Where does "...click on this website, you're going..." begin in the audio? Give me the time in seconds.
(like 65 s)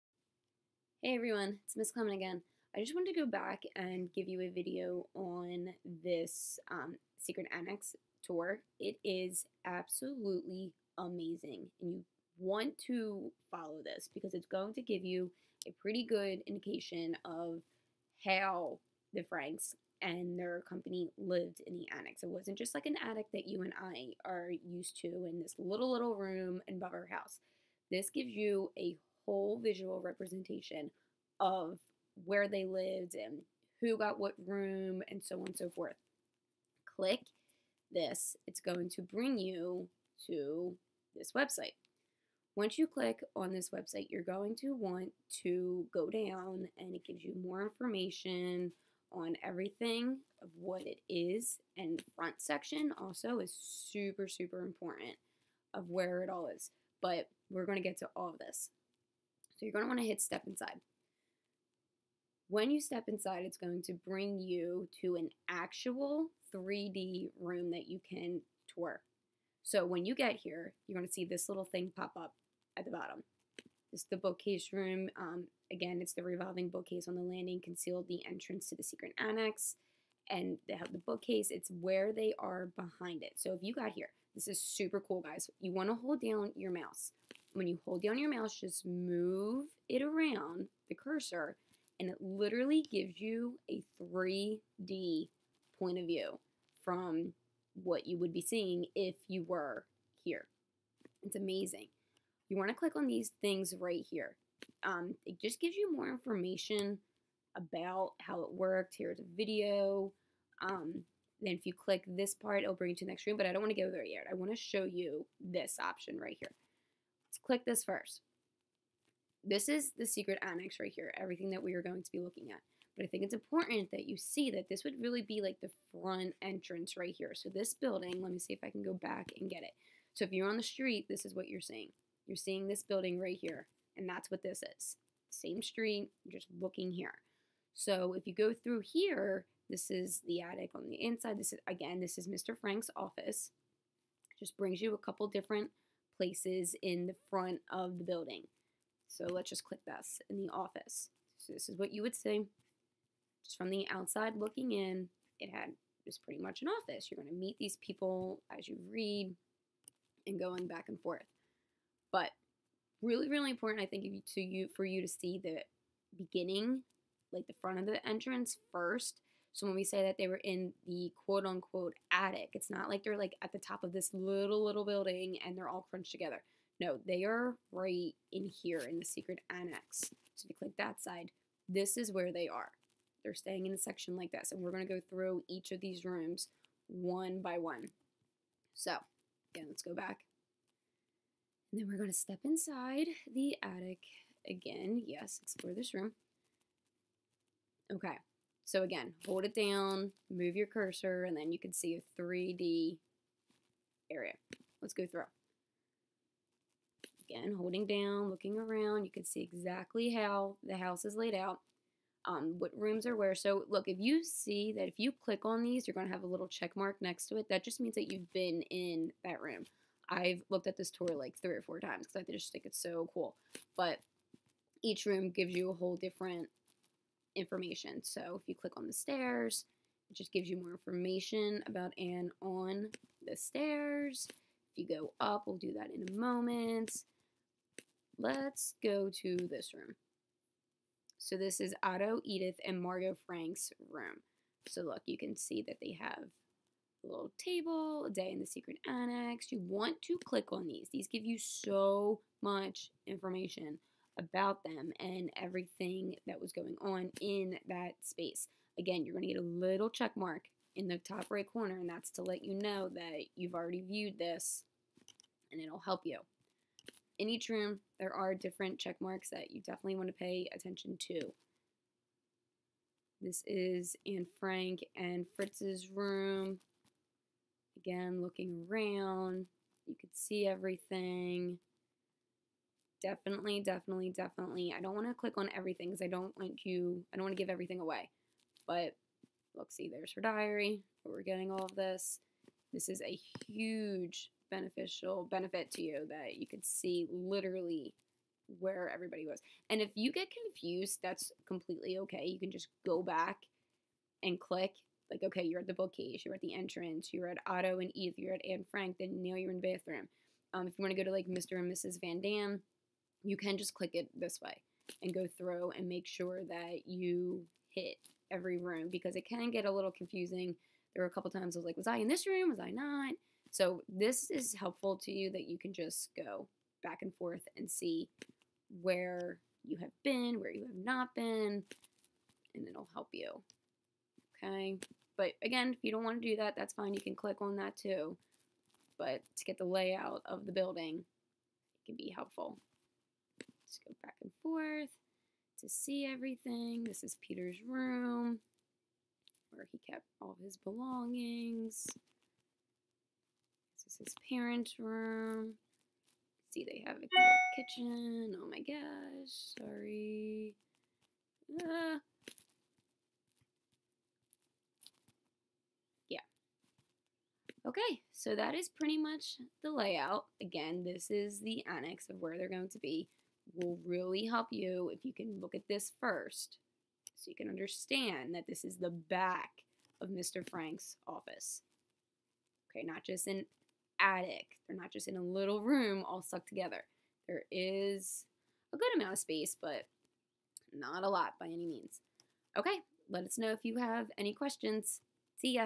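42 s.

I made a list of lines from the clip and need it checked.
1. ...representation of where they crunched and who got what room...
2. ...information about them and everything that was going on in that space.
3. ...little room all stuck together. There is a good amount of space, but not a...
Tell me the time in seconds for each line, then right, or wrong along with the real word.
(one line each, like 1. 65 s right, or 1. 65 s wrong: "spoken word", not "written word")
1. 30 s wrong: "lived", not "crunched"
2. 253 s right
3. 385 s right.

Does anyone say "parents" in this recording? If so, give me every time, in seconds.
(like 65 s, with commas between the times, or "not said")
354 s.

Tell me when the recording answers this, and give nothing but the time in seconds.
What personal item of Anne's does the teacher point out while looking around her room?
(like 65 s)
290 s.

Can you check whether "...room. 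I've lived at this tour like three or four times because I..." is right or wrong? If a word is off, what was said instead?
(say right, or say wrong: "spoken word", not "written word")
wrong: "looked", not "lived".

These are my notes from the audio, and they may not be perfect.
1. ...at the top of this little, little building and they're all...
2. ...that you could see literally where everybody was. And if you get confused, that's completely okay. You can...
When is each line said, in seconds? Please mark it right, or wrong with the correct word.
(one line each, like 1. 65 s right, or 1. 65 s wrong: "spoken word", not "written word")
1. 173 s right
2. 296 s right.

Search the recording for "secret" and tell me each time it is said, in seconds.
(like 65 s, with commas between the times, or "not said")
7 s, 78 s, 120 s, 179 s, 248 s.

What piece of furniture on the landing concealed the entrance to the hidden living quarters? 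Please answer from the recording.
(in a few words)
Revolving bookcase.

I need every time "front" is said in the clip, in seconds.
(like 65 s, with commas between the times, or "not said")
52 s, 125 s, 147 s, 167 s.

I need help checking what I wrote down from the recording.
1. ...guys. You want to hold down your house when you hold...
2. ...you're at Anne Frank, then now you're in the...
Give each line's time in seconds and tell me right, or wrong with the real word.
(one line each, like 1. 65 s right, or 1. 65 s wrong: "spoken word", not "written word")
1. 85 s wrong: "mouse", not "house"
2. 308 s right.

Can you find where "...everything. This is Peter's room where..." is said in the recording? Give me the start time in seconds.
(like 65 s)
346 s.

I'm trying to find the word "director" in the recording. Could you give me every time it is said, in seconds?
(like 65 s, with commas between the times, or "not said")
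not said.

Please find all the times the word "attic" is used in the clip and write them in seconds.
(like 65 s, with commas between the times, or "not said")
23 s, 140 s, 172 s, 193 s, 383 s.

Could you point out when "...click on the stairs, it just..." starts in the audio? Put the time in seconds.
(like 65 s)
228 s.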